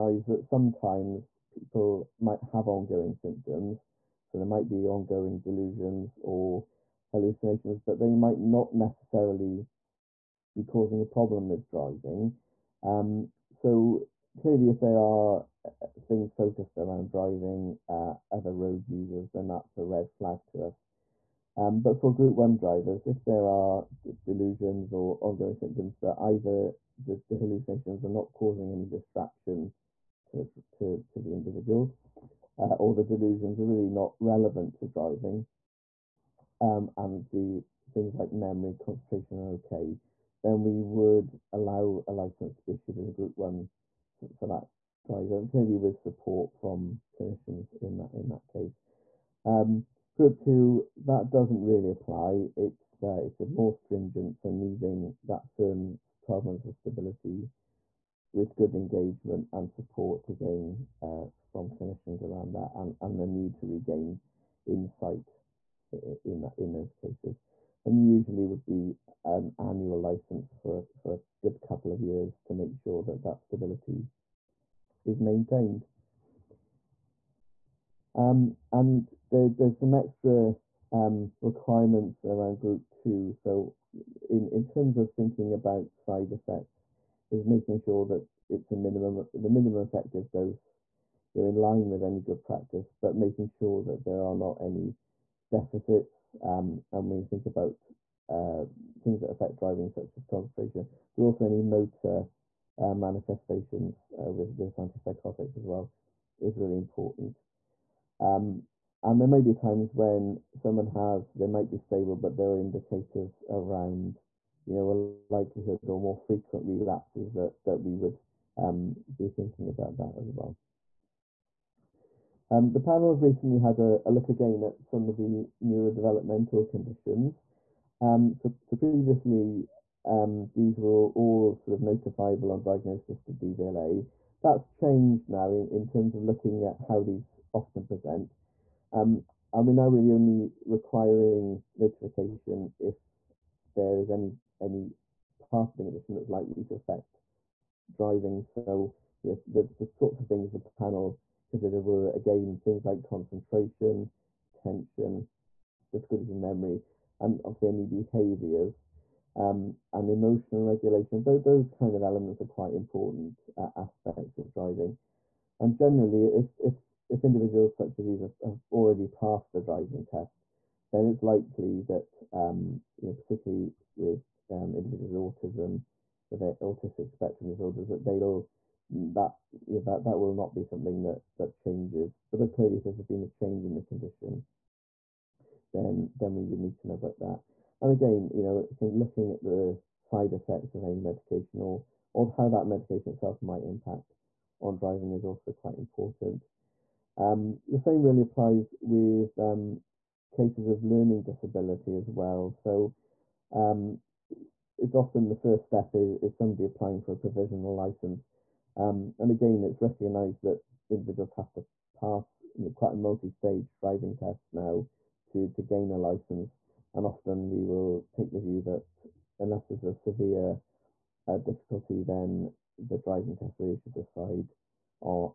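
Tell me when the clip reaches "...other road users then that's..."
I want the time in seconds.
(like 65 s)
18 s.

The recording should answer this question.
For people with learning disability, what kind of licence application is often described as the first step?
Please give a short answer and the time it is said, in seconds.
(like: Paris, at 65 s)
provisional license, at 207 s.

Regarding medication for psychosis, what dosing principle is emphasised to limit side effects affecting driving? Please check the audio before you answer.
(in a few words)
minimum effective dose.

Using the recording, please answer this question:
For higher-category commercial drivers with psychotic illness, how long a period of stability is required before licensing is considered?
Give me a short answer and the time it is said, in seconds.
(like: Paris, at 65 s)
12 months, at 56 s.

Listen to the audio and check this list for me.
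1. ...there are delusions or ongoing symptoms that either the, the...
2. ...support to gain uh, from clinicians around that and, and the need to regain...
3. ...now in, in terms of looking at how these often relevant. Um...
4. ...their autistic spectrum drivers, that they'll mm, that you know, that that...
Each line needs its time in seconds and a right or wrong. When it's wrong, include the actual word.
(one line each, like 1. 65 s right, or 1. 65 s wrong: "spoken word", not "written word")
1. 23 s right
2. 59 s right
3. 135 s wrong: "present", not "relevant"
4. 176 s wrong: "disorders", not "drivers".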